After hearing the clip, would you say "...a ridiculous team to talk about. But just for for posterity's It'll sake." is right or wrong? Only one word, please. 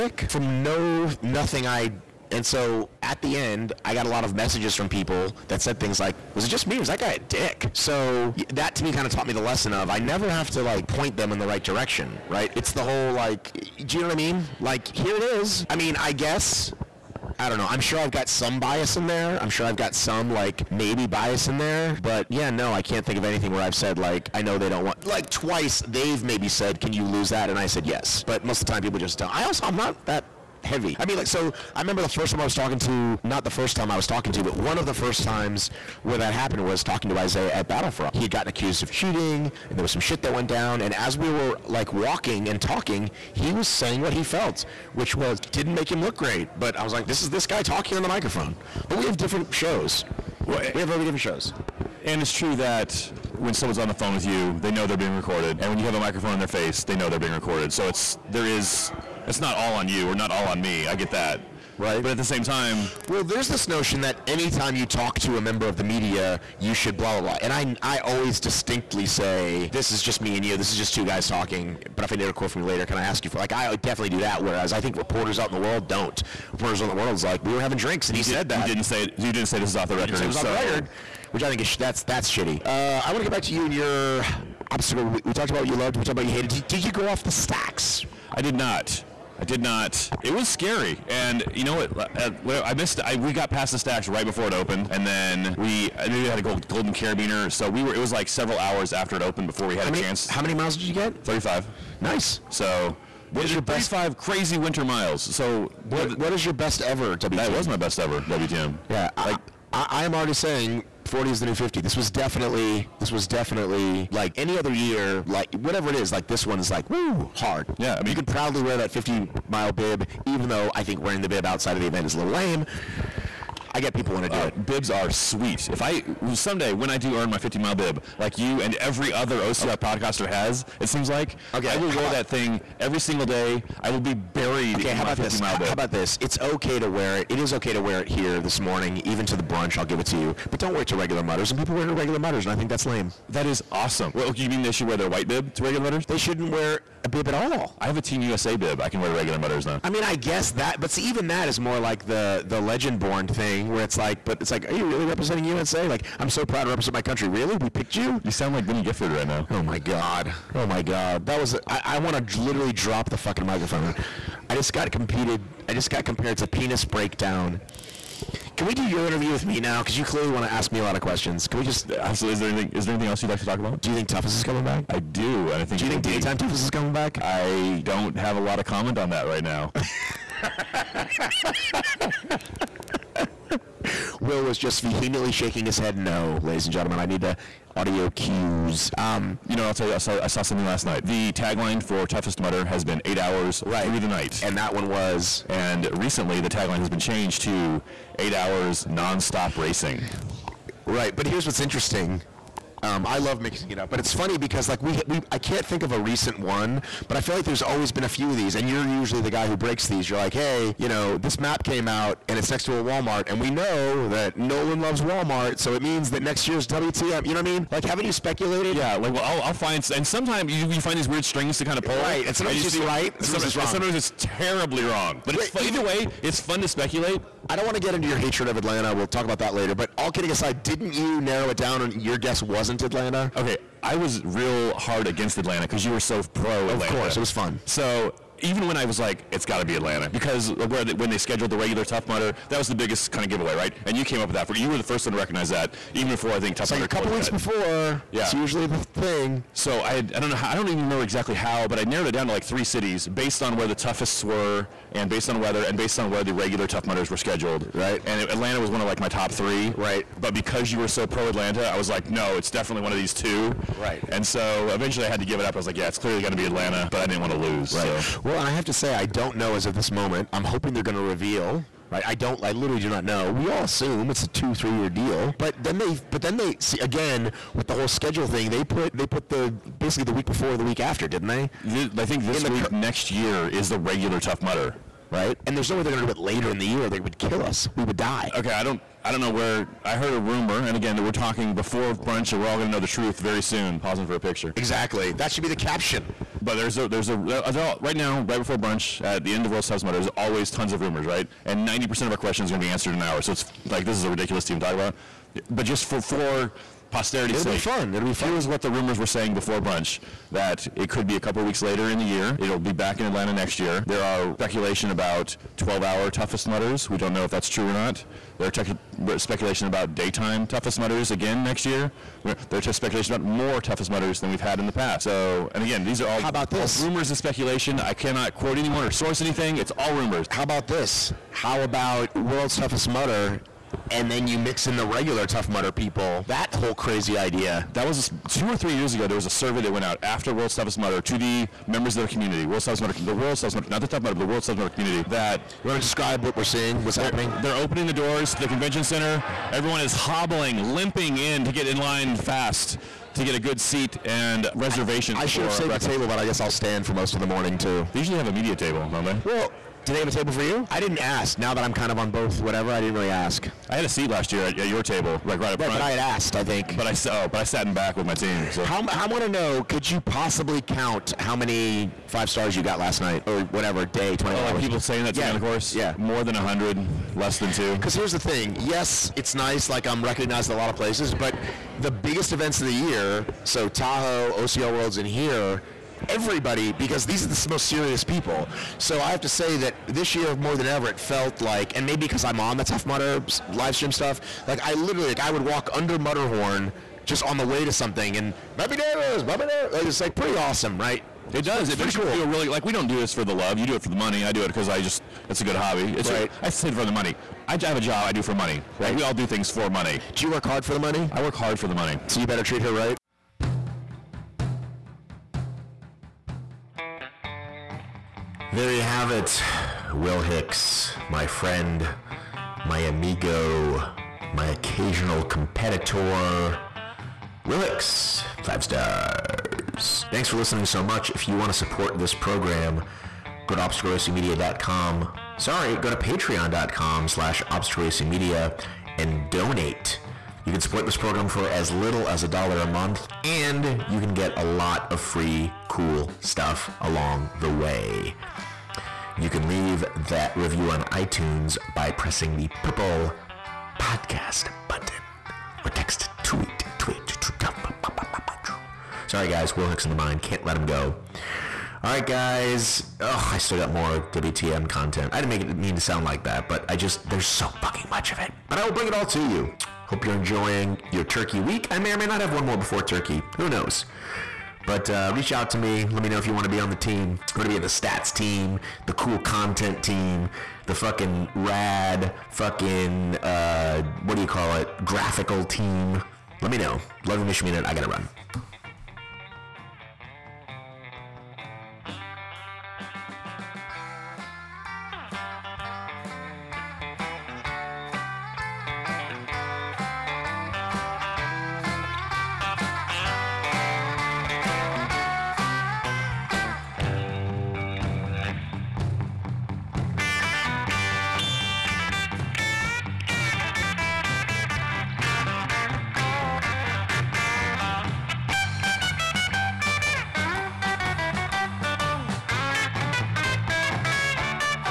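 right.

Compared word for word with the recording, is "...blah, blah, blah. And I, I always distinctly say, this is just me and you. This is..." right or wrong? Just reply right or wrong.
right.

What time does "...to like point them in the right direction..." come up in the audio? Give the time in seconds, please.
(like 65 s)
10 s.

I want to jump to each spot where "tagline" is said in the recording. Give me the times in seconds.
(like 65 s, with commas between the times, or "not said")
191 s, 196 s.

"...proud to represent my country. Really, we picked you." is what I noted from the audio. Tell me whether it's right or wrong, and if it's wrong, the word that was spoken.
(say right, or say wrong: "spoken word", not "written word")
right.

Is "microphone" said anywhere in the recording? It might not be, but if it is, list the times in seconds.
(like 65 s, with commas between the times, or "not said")
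48 s, 55 s, 163 s.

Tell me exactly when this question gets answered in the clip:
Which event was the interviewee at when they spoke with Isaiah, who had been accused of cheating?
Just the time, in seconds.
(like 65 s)
37 s.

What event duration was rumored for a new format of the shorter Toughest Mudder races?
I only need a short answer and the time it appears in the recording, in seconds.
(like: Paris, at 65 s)
12 hours, at 315 s.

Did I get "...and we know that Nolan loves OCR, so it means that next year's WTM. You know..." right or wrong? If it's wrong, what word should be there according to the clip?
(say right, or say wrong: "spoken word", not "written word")
wrong: "Walmart", not "OCR".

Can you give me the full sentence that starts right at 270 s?
I'm hoping they're going to reveal right.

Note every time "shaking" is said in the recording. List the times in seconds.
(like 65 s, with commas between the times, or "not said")
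185 s.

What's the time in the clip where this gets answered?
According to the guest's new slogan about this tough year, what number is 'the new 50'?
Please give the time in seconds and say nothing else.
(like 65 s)
111 s.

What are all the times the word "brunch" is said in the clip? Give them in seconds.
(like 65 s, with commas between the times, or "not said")
139 s, 291 s, 298 s, 309 s.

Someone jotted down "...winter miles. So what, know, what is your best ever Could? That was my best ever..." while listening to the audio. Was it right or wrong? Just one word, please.
wrong.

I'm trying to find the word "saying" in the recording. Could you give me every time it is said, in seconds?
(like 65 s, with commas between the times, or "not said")
43 s, 110 s, 309 s, 374 s.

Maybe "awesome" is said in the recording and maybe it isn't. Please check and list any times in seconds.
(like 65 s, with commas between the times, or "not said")
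143 s, 400 s.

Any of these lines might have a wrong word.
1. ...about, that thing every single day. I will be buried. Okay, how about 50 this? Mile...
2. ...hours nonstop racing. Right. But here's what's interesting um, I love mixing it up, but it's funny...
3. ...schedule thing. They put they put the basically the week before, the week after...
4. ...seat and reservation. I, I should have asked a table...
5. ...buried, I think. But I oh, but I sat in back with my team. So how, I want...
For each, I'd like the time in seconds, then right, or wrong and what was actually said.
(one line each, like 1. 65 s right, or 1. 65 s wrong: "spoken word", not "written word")
1. 132 s right
2. 198 s right
3. 277 s right
4. 353 s wrong: "saved", not "asked"
5. 365 s wrong: "asked", not "buried".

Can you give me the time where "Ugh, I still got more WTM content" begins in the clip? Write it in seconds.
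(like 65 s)
462 s.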